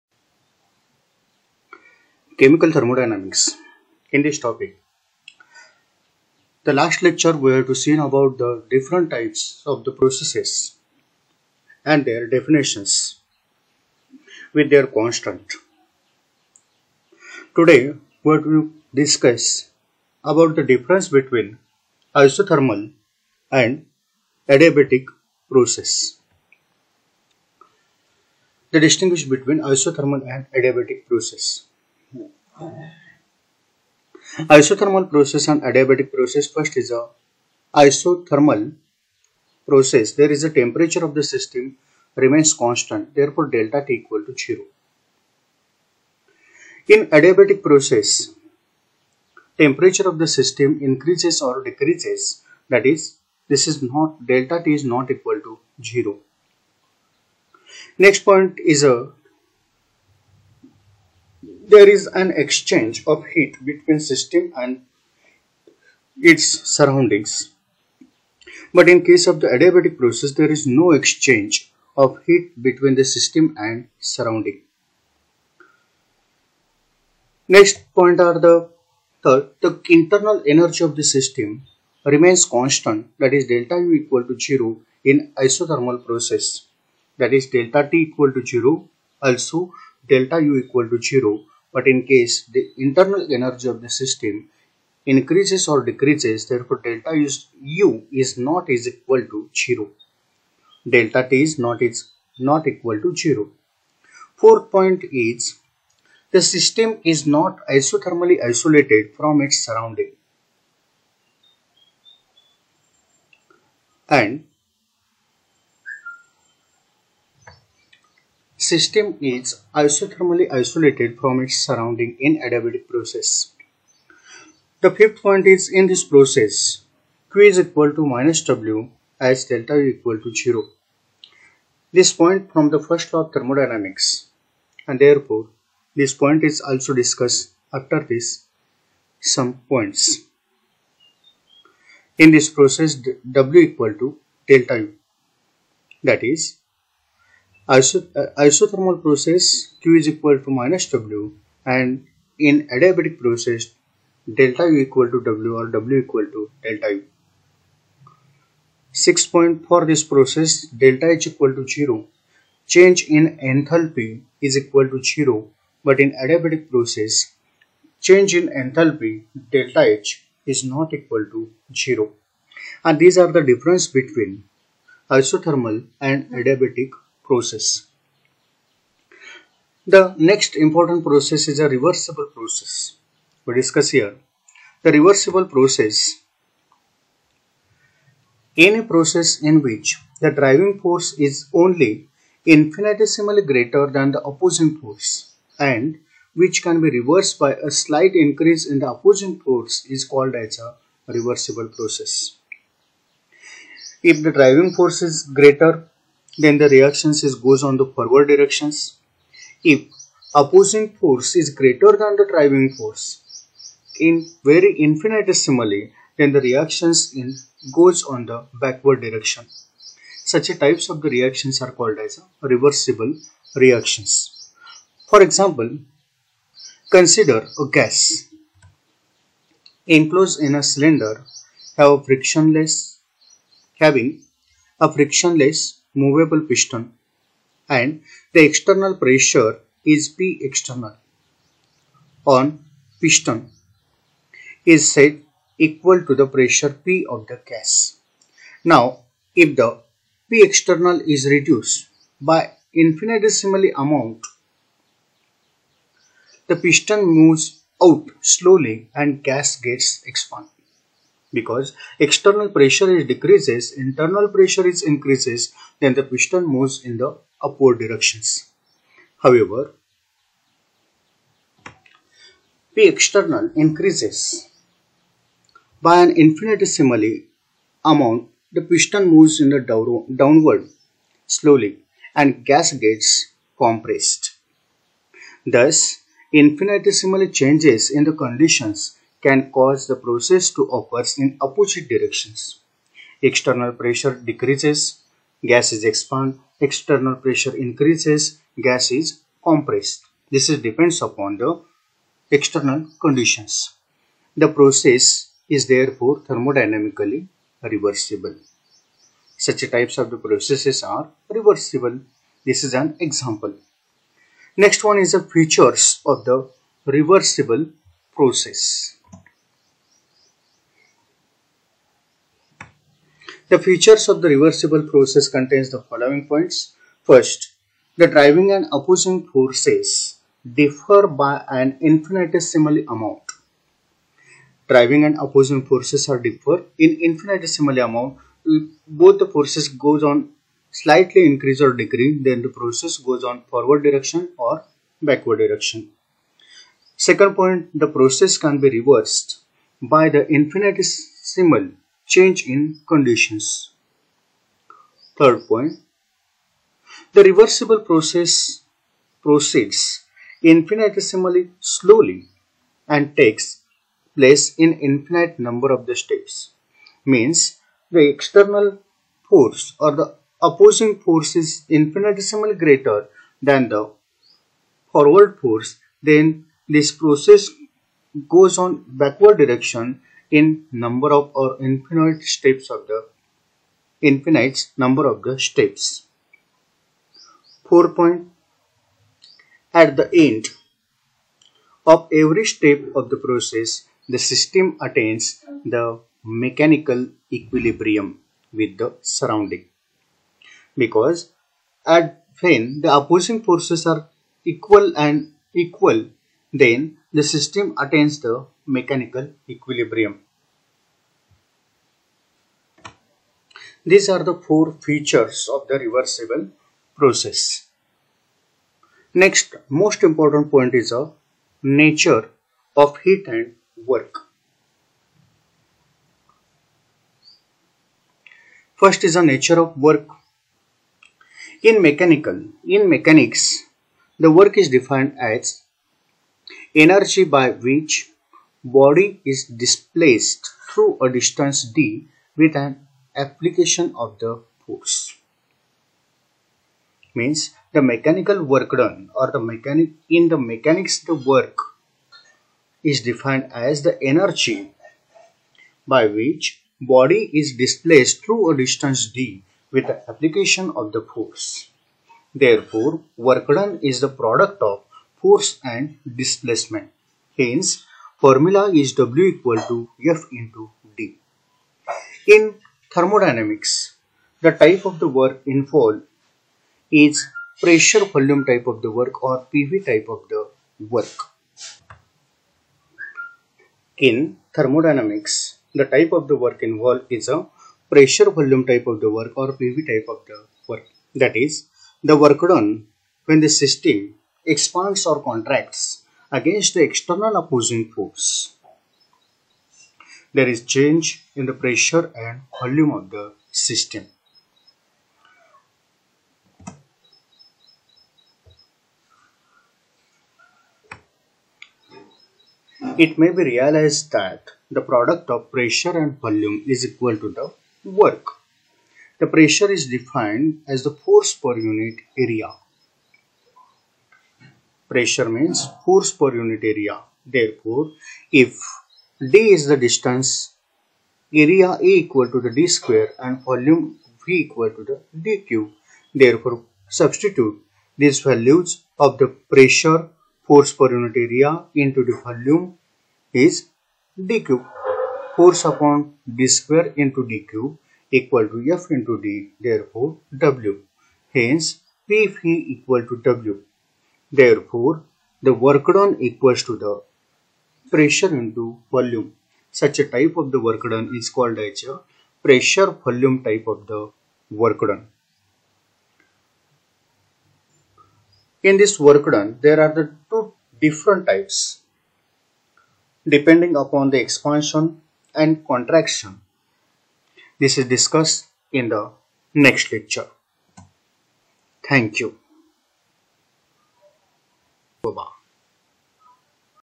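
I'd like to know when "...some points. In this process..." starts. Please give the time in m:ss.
2:19.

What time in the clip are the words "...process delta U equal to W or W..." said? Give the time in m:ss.
2:33.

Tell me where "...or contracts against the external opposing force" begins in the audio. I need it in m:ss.
8:15.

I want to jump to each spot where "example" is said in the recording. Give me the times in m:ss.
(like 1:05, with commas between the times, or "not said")
3:45, 5:12.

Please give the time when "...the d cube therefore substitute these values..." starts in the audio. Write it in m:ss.
8:54.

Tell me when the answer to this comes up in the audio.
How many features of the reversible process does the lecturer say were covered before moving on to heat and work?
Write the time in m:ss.
6:54.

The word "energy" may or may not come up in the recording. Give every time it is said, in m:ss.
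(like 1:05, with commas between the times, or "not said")
1:20, 1:33, 7:16, 7:34.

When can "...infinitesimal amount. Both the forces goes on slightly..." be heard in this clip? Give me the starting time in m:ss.
5:37.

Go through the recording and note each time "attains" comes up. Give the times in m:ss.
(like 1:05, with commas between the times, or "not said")
6:34, 6:47.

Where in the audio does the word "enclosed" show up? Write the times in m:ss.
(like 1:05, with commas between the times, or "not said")
3:49.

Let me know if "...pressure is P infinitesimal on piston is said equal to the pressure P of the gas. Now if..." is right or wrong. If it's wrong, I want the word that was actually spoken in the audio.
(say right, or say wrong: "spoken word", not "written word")
wrong: "external", not "infinitesimal".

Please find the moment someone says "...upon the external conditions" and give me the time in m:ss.
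5:01.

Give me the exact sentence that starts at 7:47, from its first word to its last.
Hence, formula is W equal to F into D.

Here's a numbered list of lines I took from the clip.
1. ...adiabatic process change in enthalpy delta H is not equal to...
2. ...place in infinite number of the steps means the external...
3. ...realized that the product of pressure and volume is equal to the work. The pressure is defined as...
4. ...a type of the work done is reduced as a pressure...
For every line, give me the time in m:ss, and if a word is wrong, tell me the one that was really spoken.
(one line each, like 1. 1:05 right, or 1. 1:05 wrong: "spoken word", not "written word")
1. 2:46 right
2. 6:04 right
3. 8:33 right
4. 9:19 wrong: "called", not "reduced".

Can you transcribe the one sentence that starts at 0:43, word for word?
Therefore, delta T equal to 0.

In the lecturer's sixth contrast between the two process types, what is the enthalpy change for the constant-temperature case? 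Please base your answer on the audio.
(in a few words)
delta H equal to 0.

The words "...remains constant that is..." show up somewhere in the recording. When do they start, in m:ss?
1:22.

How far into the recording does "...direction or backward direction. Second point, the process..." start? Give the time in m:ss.
5:43.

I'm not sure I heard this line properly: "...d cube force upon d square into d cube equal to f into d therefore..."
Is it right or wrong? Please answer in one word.
right.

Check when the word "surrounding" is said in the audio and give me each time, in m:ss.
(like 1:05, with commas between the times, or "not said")
1:06, 1:13, 1:49, 2:01, 6:39.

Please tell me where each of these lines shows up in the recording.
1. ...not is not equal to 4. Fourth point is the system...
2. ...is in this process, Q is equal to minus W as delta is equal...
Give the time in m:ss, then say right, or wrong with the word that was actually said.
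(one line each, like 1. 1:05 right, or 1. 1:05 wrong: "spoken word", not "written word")
1. 1:41 wrong: "0", not "4"
2. 2:05 right.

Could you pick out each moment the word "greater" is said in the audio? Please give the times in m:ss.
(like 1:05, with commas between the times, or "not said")
3:13, 3:25, 3:31, 6:12.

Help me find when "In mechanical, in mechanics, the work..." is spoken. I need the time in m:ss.
7:11.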